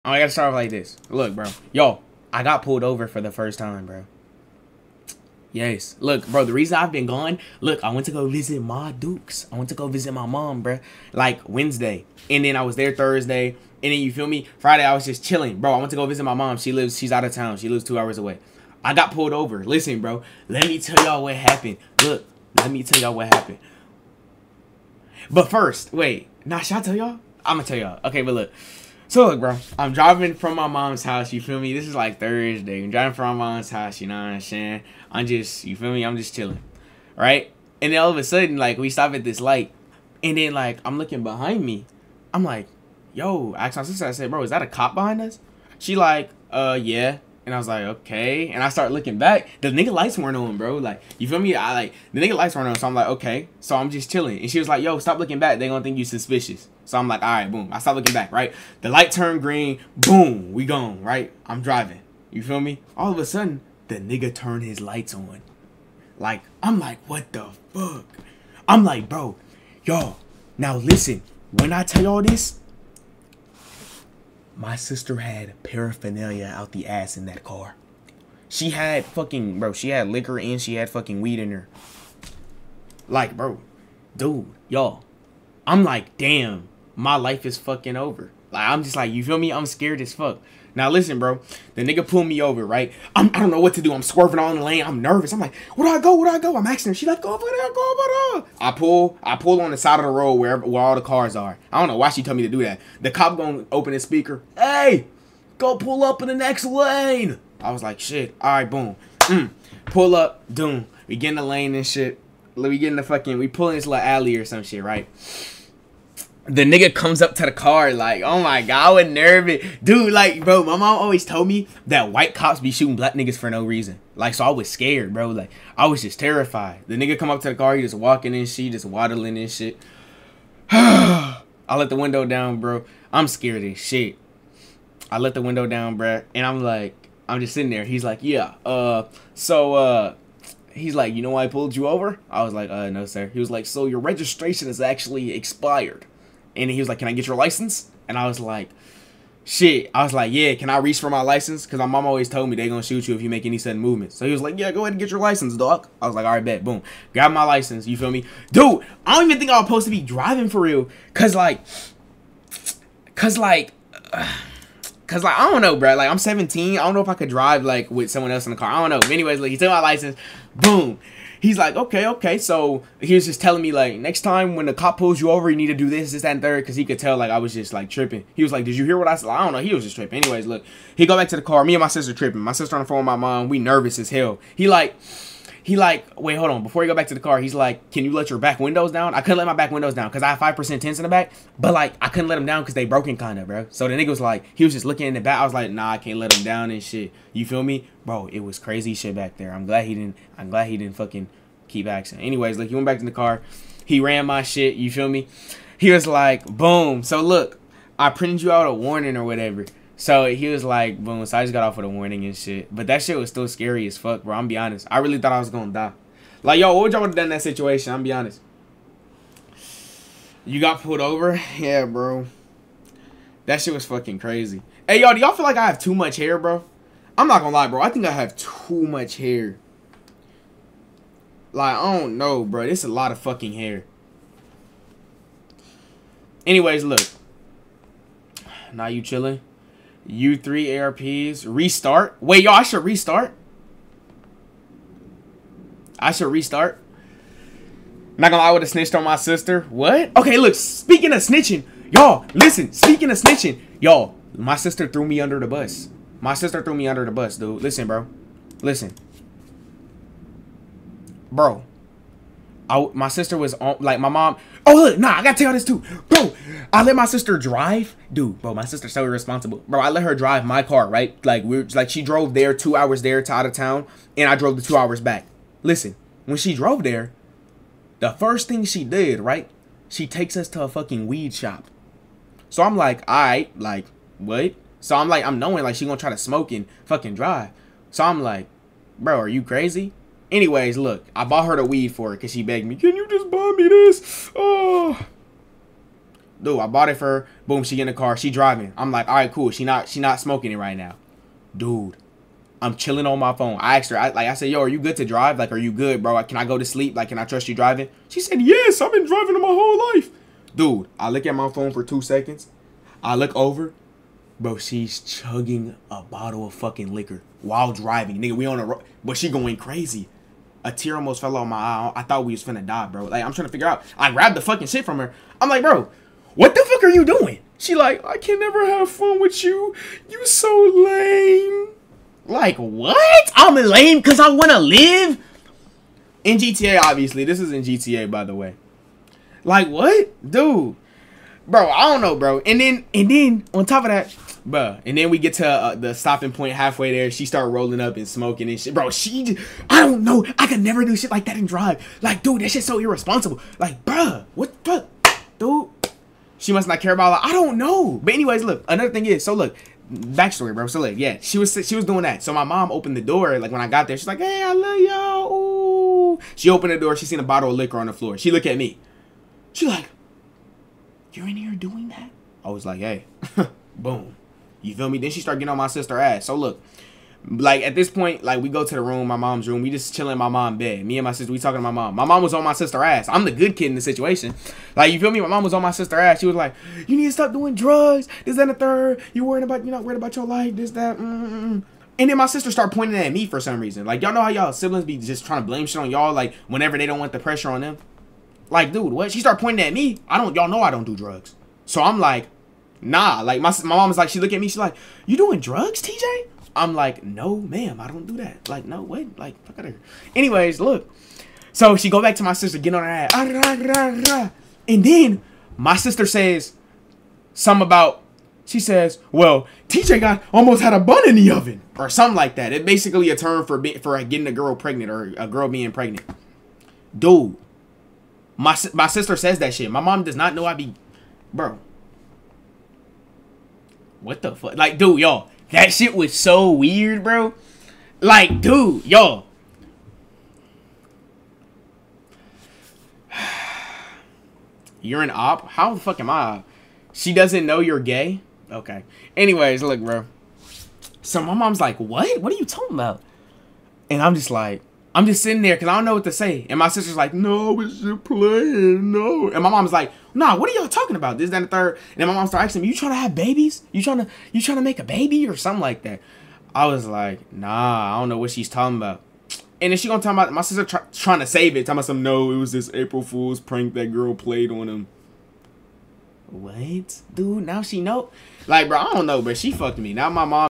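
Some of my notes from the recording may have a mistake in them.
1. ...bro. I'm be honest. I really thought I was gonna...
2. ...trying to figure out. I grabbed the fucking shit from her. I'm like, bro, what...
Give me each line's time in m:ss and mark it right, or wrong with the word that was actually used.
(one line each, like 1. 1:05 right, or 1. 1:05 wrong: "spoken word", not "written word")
1. 3:34 right
2. 5:23 right.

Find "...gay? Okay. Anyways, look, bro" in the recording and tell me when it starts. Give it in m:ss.
7:27.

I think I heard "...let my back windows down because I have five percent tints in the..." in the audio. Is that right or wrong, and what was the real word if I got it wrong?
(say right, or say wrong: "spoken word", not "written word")
right.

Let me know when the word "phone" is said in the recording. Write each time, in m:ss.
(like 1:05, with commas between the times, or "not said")
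3:02, 5:03, 5:11.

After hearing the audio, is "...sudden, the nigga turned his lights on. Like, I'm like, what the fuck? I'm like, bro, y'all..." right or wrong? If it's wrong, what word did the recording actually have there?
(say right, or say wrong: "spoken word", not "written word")
right.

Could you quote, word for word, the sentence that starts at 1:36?
She like, go over there, go over there.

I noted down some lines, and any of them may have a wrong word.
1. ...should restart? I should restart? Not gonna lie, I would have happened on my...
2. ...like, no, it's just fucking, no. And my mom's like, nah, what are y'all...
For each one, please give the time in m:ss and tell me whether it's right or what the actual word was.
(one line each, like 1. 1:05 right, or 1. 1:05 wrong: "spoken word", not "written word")
1. 4:02 wrong: "snitched", not "happened"
2. 7:36 wrong: "playing", not "fucking".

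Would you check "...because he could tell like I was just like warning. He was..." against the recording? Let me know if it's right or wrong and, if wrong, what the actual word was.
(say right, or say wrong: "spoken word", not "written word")
wrong: "tripping", not "warning".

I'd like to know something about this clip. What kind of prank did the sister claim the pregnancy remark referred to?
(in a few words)
April Fool's prank.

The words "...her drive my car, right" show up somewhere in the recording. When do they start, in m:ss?
4:30.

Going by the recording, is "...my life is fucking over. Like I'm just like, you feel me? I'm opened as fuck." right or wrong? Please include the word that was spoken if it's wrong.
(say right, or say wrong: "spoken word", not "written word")
wrong: "scared", not "opened".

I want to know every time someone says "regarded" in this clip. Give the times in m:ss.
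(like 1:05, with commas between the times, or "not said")
not said.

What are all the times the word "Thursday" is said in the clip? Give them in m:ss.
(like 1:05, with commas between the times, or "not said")
0:12, 0:32.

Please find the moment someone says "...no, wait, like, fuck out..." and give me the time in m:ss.
6:48.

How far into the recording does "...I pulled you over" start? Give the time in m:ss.
2:21.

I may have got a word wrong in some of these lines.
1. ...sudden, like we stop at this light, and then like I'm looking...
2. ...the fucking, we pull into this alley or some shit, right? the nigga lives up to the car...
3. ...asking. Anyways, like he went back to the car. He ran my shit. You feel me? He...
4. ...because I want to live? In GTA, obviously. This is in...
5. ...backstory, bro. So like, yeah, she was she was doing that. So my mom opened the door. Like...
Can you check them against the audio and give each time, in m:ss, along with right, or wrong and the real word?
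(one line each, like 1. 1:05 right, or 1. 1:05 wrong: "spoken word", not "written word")
1. 0:38 right
2. 1:52 wrong: "comes", not "lives"
3. 3:21 right
4. 5:33 right
5. 5:59 right.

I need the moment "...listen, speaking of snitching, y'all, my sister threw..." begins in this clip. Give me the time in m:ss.
4:12.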